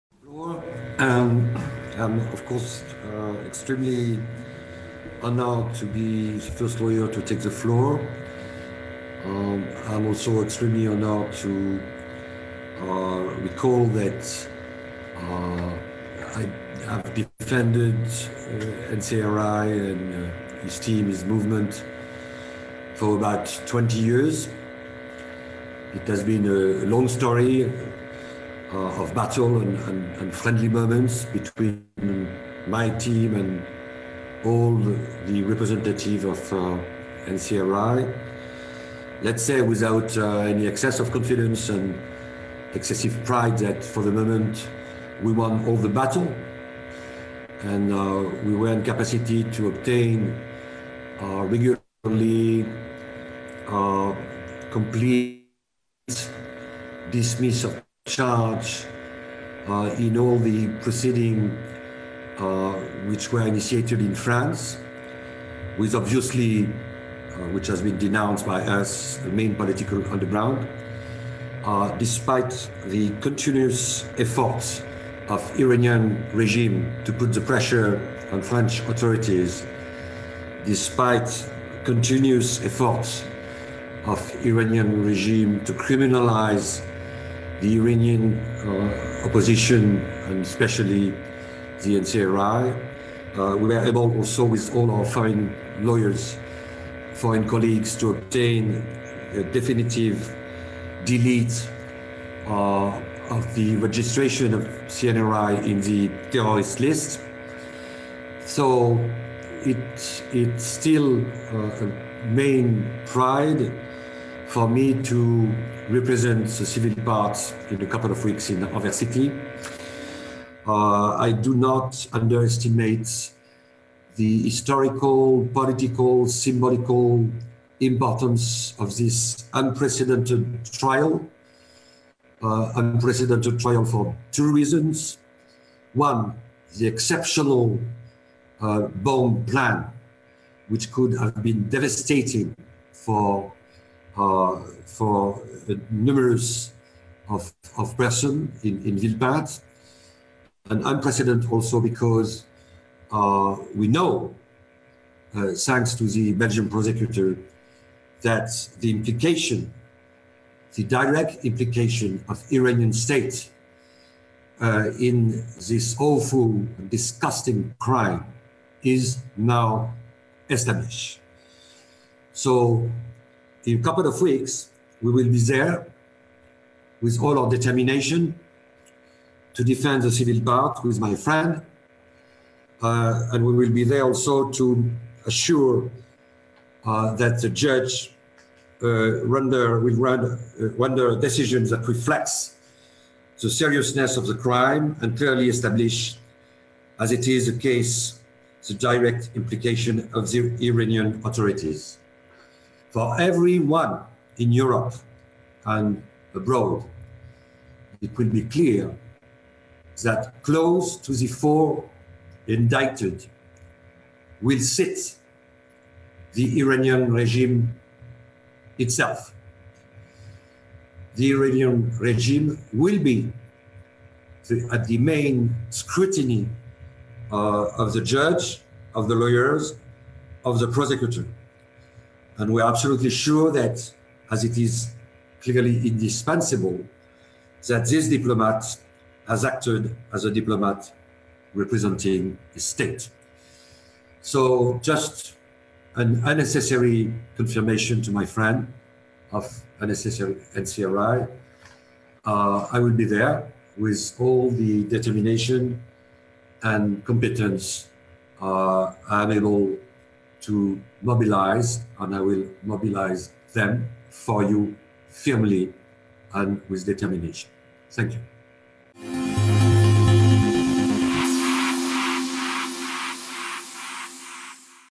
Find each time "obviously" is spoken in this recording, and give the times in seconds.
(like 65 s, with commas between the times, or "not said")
65 s.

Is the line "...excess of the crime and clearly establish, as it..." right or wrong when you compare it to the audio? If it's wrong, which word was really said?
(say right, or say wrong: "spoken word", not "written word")
wrong: "seriousness", not "excess".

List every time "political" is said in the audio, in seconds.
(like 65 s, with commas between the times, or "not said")
69 s, 125 s.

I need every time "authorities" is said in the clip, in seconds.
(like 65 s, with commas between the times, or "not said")
78 s, 201 s.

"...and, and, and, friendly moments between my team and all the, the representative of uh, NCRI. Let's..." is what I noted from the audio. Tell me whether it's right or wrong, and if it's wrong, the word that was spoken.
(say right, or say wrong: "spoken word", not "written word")
right.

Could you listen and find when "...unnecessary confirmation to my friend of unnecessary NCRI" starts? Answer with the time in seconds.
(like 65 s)
246 s.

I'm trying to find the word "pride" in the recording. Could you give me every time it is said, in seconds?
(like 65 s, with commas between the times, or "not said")
43 s, 113 s.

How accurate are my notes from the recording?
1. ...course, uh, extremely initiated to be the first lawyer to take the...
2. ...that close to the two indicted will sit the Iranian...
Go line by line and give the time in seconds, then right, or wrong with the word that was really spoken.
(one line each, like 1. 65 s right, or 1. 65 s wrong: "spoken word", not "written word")
1. 2 s wrong: "honored", not "initiated"
2. 210 s wrong: "four", not "two".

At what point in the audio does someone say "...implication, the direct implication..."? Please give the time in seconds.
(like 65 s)
158 s.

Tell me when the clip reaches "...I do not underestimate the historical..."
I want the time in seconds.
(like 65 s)
121 s.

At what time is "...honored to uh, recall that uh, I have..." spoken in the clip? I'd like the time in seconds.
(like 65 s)
10 s.